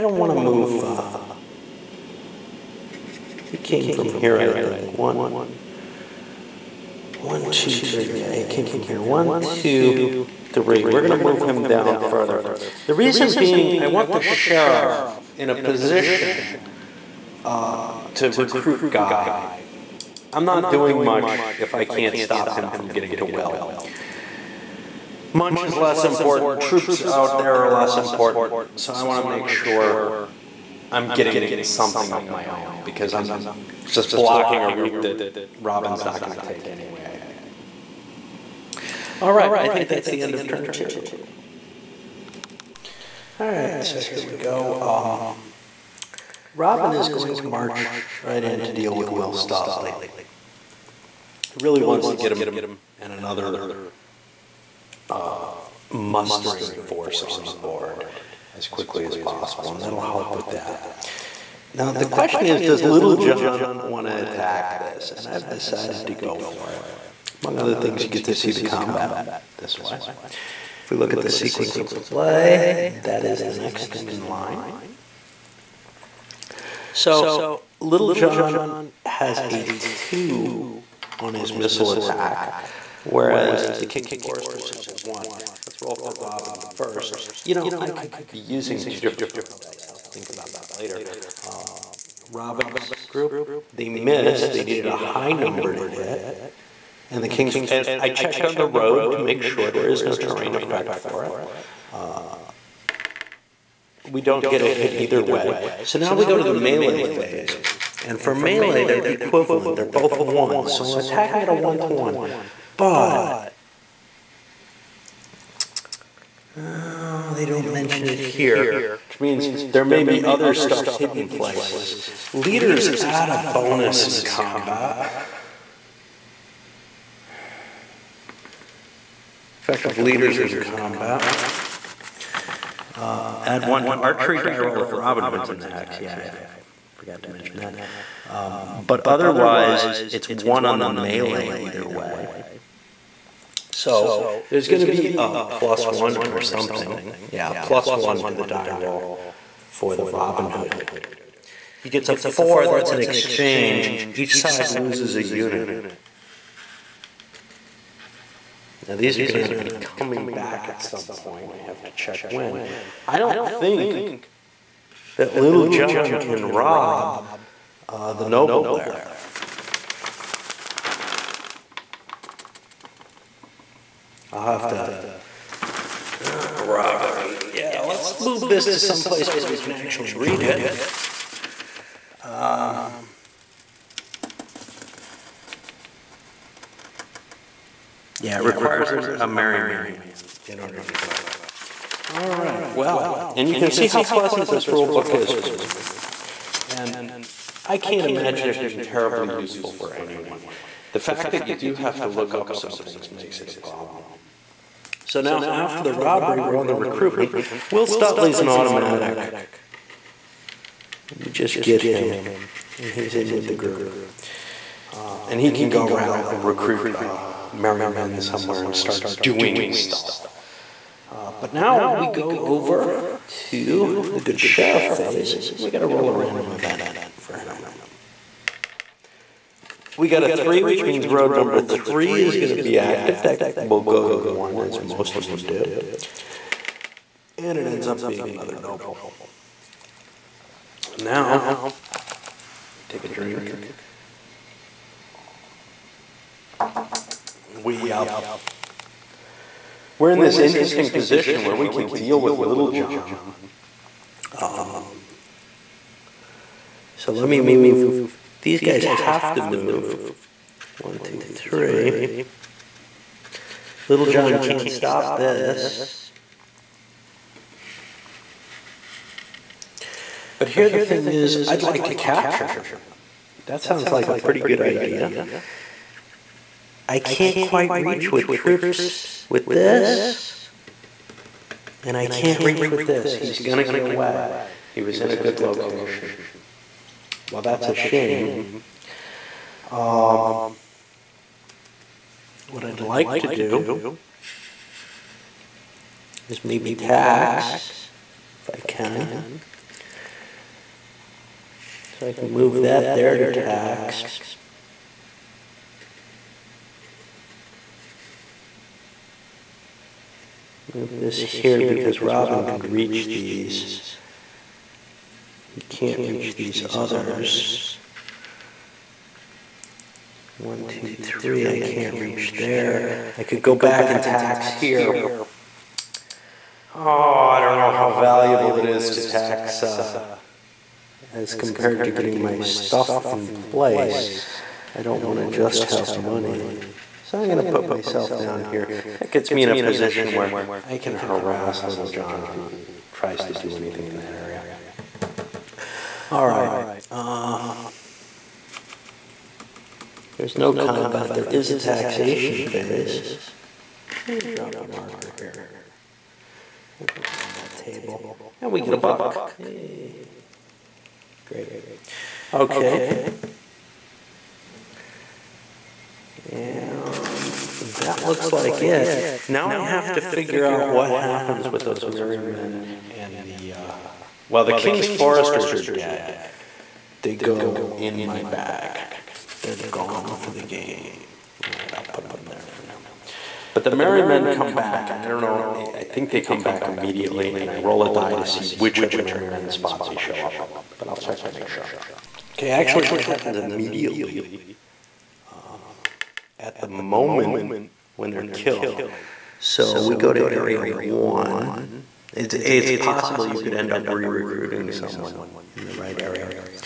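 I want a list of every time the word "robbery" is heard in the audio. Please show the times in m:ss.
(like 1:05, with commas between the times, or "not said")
2:56, 3:25.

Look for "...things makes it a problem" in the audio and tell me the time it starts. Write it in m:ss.
3:22.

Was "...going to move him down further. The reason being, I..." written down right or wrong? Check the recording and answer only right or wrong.
right.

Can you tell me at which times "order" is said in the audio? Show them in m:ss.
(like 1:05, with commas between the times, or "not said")
3:10.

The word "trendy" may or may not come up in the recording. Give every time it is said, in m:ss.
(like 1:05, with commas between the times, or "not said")
not said.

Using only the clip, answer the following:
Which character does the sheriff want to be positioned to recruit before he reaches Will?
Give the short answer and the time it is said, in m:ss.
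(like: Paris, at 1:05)
Guy, at 0:18.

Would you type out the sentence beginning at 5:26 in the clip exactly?
Oh, I don't know how valuable it is to tax uh, as compared to getting my stuff in place.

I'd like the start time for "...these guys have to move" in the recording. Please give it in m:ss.
4:18.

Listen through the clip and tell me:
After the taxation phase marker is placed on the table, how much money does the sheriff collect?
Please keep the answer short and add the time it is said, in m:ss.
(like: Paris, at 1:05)
a buck, at 5:58.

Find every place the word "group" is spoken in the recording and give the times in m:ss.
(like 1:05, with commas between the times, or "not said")
1:33, 3:33.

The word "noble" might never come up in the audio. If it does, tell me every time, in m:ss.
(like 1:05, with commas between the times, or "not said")
2:48, 3:58.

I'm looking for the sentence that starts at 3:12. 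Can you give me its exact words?
All right, well, and you can see how pleasant this rule book is for me.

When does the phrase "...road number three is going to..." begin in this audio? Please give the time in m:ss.
3:51.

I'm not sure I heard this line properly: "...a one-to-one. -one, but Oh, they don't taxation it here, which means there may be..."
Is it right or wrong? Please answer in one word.
wrong.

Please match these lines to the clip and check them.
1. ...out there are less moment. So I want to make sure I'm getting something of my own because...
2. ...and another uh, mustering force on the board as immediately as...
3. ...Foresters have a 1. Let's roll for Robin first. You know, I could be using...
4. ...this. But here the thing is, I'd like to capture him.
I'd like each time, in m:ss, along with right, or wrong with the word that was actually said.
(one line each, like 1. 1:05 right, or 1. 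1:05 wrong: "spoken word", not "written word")
1. 0:27 wrong: "important", not "moment"
2. 0:52 wrong: "quickly", not "immediately"
3. 1:24 right
4. 4:25 right.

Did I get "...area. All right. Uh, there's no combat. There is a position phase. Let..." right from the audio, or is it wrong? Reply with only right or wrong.
wrong.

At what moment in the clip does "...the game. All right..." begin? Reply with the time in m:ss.
6:20.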